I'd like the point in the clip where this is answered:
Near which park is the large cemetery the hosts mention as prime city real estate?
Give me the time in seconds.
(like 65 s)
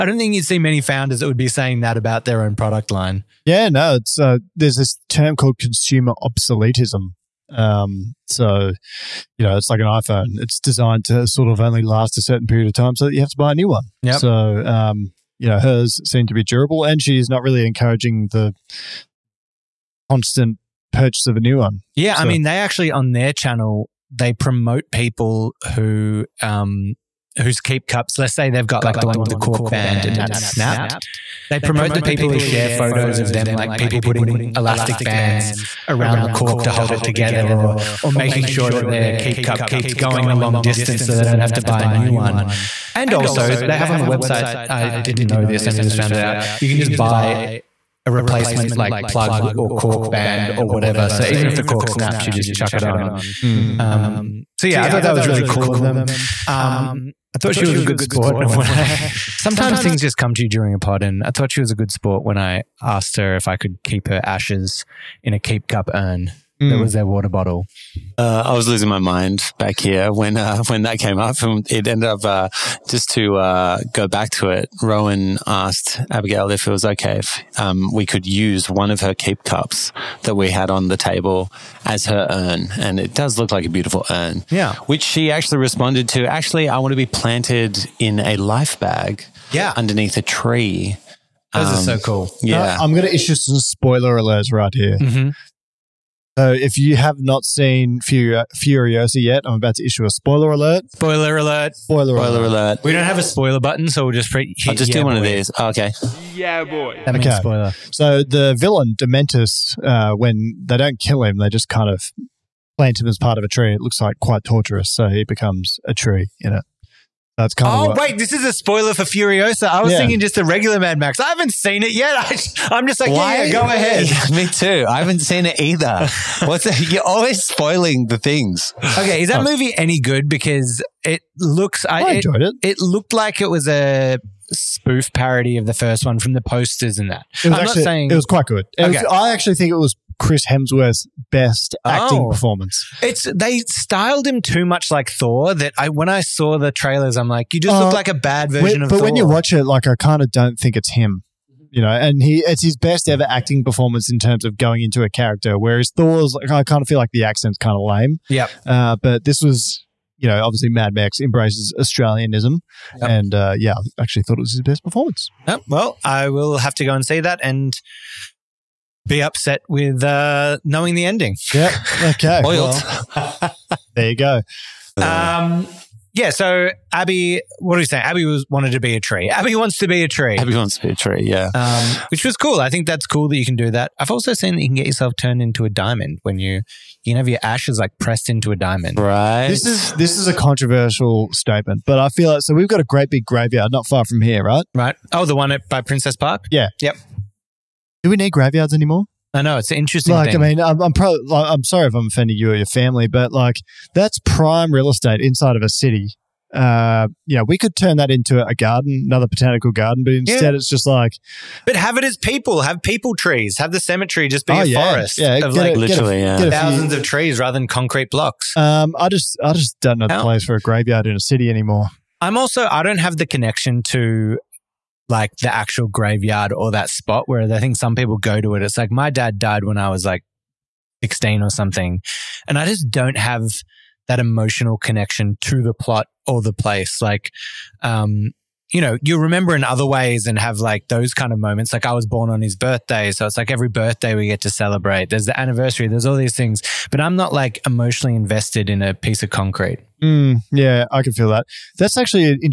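195 s.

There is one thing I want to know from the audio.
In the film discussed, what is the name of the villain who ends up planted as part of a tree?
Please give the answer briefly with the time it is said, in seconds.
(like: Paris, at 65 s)
Dementus, at 108 s.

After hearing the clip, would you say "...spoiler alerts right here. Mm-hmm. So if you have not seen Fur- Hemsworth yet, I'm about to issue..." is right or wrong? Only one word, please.
wrong.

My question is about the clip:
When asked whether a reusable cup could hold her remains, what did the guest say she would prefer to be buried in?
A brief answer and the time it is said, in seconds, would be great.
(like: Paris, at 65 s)
a life bag, at 88 s.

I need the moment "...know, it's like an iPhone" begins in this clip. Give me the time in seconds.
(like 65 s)
9 s.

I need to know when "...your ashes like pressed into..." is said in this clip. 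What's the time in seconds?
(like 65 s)
187 s.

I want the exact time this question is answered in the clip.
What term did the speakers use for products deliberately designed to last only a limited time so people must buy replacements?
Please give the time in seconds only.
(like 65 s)
5 s.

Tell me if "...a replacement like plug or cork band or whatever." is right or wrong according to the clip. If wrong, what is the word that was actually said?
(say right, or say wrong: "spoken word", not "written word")
right.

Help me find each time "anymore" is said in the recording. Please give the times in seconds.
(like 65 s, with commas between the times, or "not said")
198 s, 221 s.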